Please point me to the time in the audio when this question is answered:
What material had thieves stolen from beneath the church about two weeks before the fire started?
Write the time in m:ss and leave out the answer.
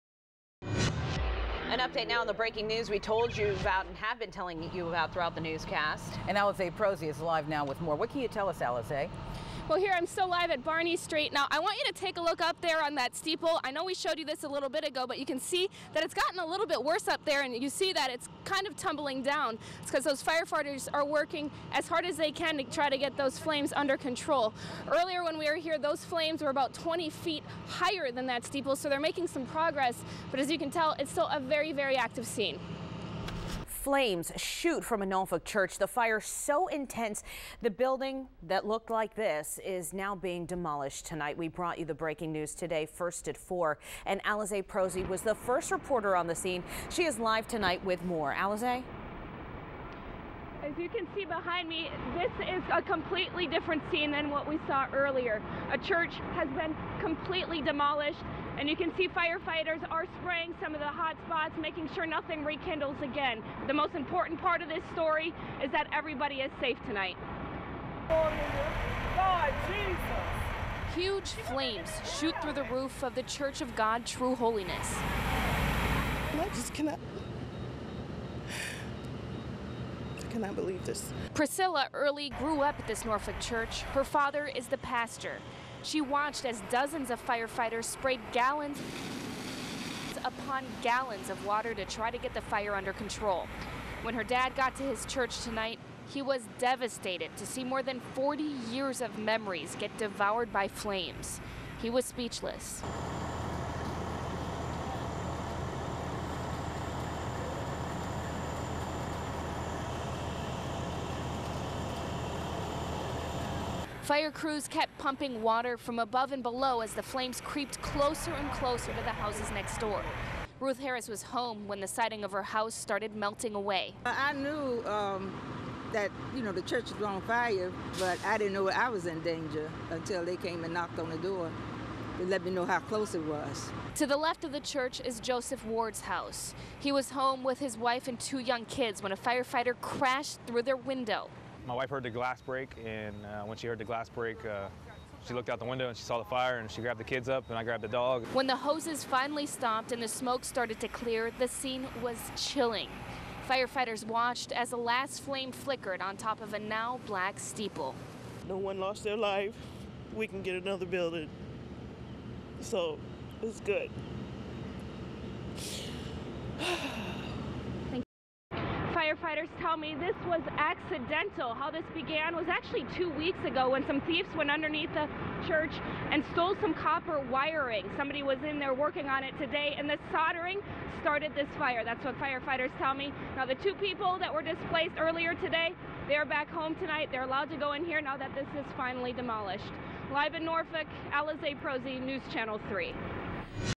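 2:56.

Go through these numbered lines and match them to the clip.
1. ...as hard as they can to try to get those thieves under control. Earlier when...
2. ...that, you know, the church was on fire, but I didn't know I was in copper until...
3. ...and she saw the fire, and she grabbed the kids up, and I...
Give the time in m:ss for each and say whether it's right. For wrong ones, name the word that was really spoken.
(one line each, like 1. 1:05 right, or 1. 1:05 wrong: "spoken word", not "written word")
1. 0:21 wrong: "flames", not "thieves"
2. 2:05 wrong: "danger", not "copper"
3. 2:25 right.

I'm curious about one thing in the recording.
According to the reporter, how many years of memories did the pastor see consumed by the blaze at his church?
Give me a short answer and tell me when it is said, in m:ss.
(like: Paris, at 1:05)
40, at 1:38.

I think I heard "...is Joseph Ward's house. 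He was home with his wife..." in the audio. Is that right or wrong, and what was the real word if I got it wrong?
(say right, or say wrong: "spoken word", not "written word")
right.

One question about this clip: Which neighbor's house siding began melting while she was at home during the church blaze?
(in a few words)
Ruth Harris.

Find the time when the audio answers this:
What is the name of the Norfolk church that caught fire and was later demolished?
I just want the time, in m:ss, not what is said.
1:13.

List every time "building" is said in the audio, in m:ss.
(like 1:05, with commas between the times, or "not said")
0:37, 2:40.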